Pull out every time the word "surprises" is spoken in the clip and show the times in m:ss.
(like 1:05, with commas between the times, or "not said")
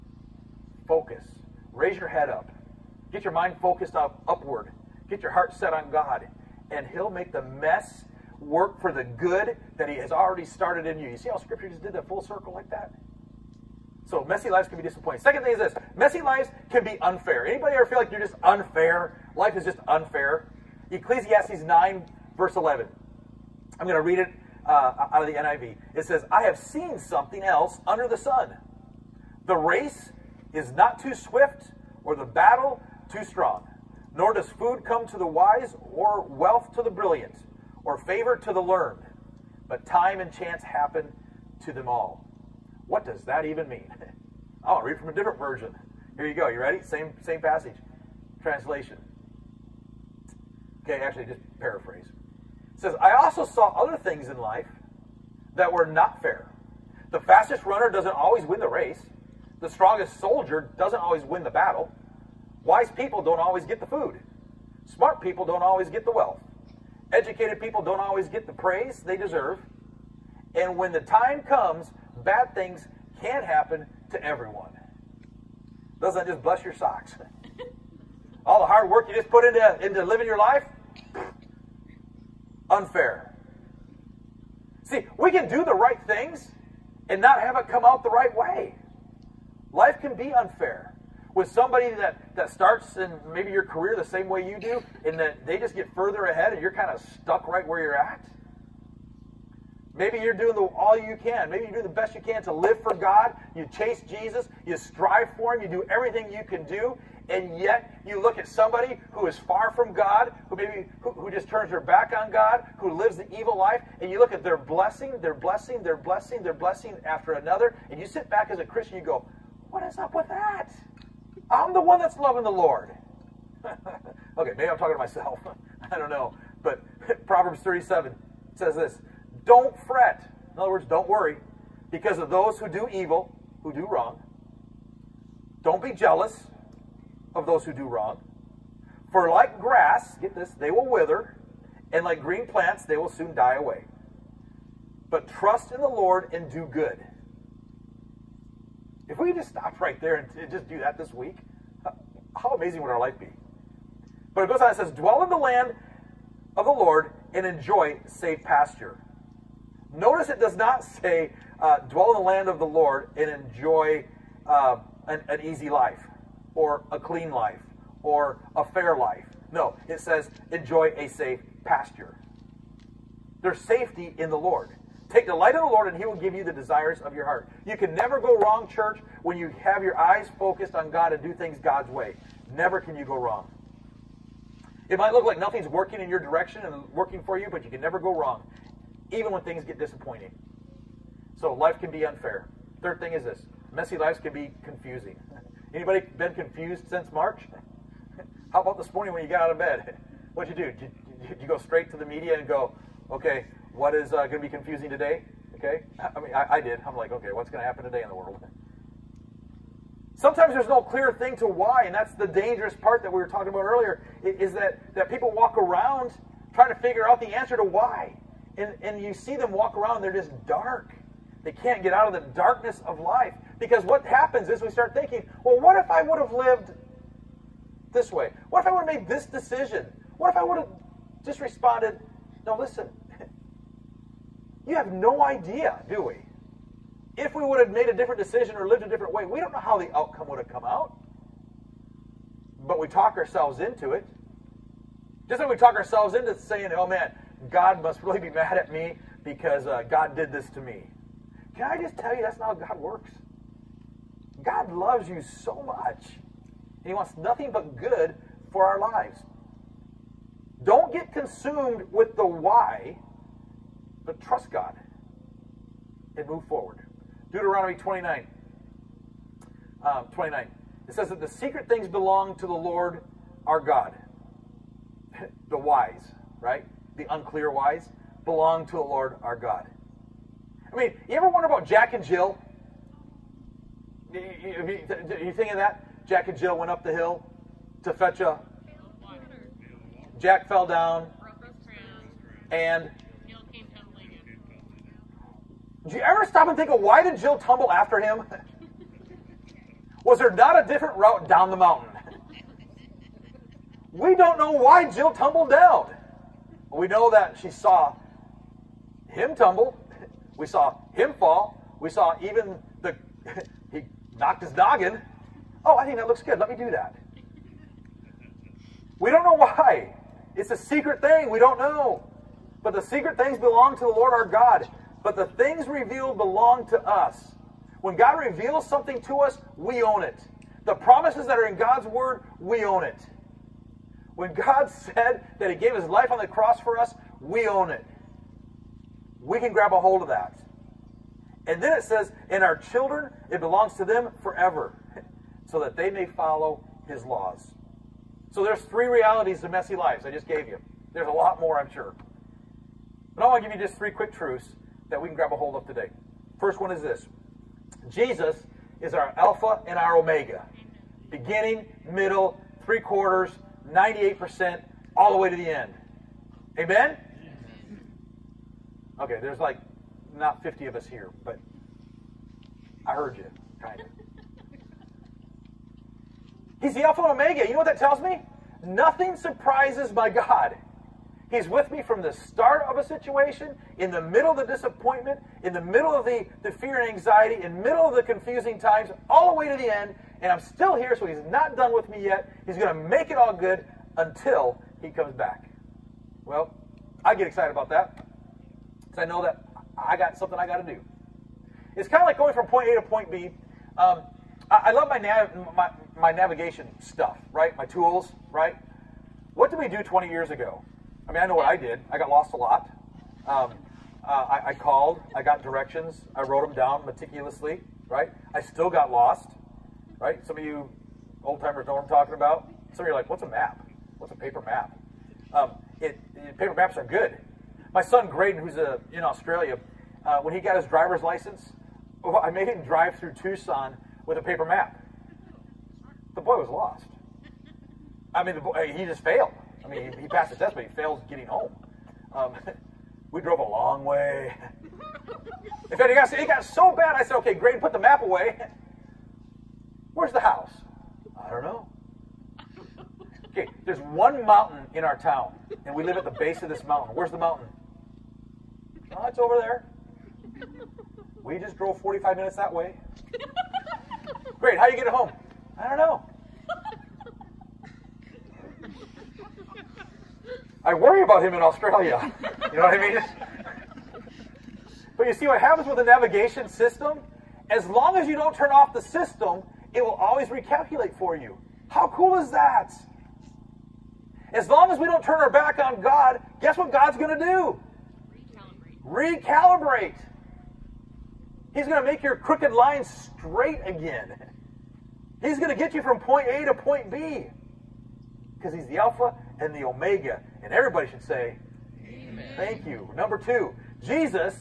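6:19.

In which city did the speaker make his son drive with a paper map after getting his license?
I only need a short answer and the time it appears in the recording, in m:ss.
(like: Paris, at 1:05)
Tucson, at 7:13.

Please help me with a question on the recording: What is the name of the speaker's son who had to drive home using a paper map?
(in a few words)
Graydon.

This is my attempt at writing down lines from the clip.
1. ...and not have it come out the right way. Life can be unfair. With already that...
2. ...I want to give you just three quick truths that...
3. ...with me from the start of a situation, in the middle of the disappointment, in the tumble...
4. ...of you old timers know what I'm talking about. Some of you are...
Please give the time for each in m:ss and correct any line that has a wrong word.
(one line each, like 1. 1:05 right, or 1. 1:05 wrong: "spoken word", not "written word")
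1. 1:27 wrong: "somebody", not "already"
2. 5:53 right
3. 6:21 wrong: "middle", not "tumble"
4. 7:00 right.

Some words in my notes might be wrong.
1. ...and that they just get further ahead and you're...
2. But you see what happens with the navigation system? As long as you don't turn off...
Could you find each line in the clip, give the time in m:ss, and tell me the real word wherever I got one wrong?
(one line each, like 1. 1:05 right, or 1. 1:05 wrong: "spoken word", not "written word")
1. 1:35 right
2. 7:54 right.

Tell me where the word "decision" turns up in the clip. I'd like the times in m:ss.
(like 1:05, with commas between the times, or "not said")
3:49, 3:58.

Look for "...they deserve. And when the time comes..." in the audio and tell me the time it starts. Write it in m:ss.
1:08.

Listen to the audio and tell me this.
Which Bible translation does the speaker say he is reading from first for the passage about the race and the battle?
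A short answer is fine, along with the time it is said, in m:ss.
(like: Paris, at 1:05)
NIV, at 0:25.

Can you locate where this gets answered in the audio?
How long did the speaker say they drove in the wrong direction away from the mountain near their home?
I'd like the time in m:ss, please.
7:41.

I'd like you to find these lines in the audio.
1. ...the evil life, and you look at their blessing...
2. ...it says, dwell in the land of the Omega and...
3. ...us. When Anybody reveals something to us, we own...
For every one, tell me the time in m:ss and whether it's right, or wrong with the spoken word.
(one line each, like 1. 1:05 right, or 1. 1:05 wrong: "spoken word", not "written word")
1. 1:53 right
2. 2:34 wrong: "Lord", not "Omega"
3. 5:26 wrong: "God", not "Anybody".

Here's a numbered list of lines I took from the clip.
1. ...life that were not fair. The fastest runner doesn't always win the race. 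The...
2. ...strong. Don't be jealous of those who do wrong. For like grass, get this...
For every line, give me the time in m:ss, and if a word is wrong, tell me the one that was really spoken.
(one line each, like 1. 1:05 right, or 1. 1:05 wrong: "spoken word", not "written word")
1. 0:54 right
2. 2:13 wrong: "wrong", not "strong".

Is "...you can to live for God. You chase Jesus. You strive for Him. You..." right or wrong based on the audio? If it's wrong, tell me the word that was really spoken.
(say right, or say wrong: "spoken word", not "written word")
right.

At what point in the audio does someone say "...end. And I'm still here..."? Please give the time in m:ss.
6:29.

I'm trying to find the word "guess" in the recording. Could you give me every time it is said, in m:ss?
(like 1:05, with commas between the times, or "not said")
8:06.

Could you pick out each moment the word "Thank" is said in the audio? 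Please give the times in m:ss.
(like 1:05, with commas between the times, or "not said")
8:22.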